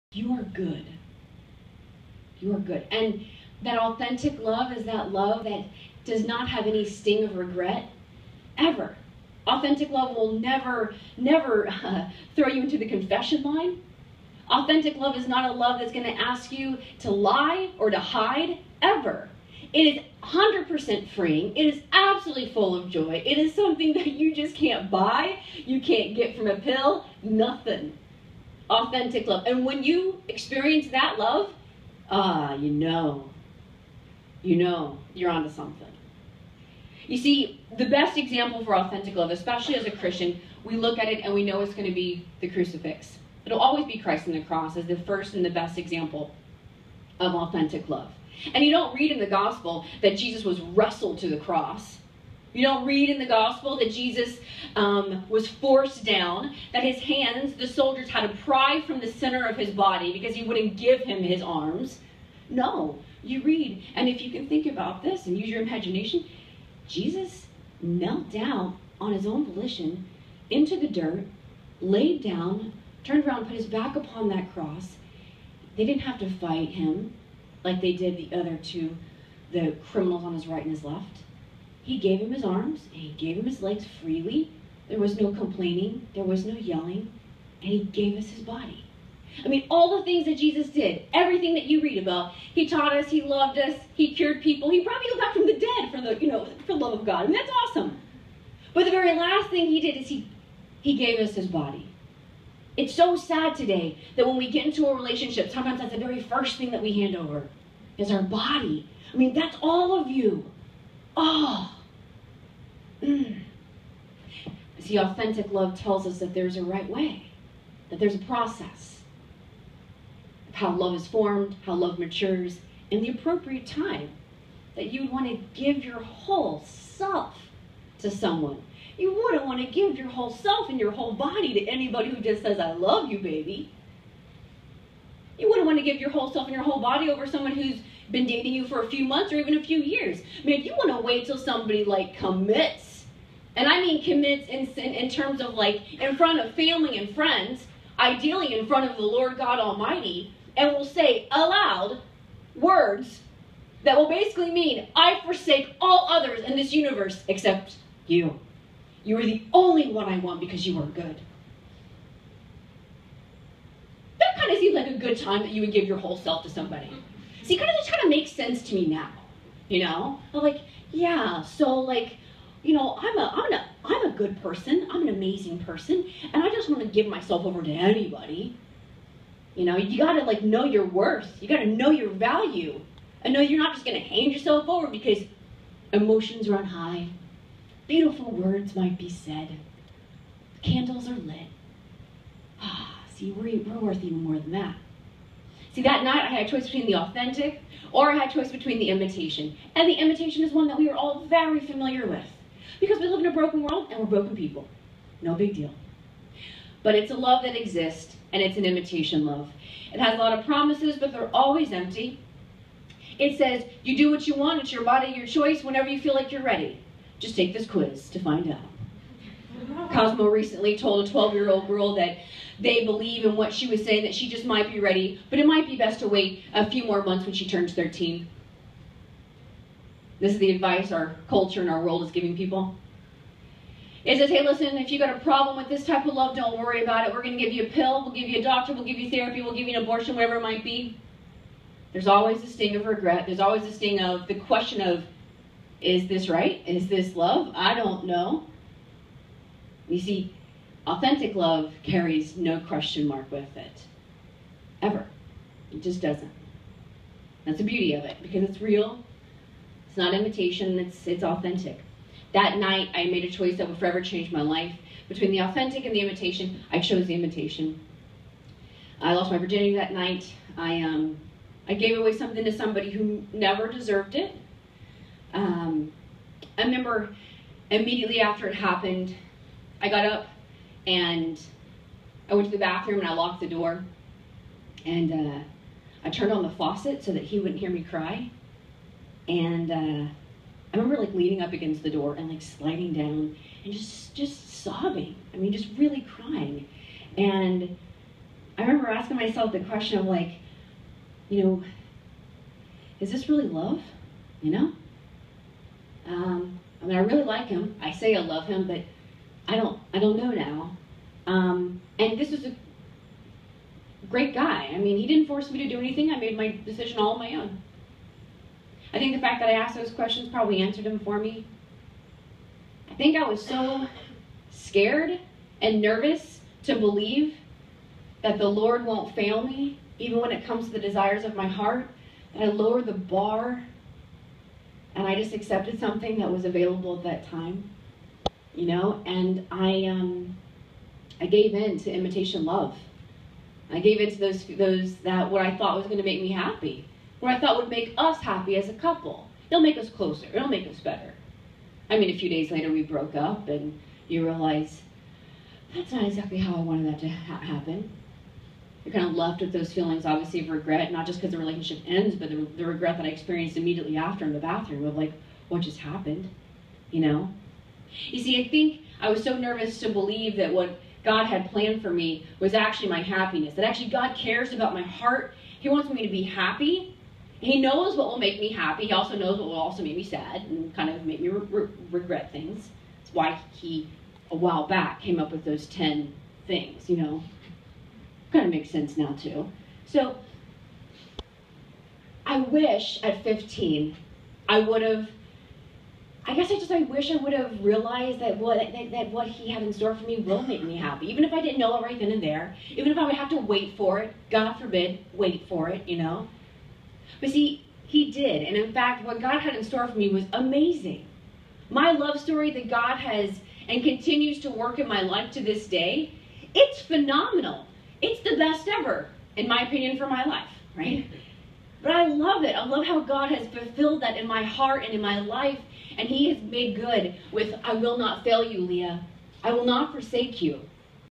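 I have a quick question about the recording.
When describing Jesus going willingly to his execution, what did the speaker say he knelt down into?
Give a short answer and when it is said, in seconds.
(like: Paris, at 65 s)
The dirt, at 70 s.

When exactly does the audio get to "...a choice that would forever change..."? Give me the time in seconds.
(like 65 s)
263 s.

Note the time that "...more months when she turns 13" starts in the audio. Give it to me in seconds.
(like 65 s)
226 s.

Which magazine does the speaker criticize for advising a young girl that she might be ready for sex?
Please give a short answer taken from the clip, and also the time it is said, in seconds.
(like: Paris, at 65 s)
Cosmo, at 219 s.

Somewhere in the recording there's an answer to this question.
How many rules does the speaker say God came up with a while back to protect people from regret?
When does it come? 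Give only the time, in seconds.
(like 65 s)
385 s.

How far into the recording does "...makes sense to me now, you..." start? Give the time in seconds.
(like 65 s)
168 s.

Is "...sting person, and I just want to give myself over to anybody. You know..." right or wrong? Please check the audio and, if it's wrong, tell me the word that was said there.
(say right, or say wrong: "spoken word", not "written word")
wrong: "amazing", not "sting".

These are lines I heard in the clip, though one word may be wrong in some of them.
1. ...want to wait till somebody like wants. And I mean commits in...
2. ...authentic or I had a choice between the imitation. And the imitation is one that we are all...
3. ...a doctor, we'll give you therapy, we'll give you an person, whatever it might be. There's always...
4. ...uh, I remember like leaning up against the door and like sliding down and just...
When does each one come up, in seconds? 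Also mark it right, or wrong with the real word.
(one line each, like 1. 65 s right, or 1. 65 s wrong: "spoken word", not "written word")
1. 140 s wrong: "commits", not "wants"
2. 196 s right
3. 238 s wrong: "abortion", not "person"
4. 289 s right.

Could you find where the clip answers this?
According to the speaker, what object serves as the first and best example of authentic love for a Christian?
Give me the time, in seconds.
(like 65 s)
42 s.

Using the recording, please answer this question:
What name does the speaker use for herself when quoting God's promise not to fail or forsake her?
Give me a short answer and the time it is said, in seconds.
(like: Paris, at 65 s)
Leah, at 428 s.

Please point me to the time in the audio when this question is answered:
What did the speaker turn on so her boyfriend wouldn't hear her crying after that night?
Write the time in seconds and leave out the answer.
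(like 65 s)
286 s.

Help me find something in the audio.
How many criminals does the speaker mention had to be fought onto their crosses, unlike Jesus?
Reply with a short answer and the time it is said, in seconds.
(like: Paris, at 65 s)
2, at 78 s.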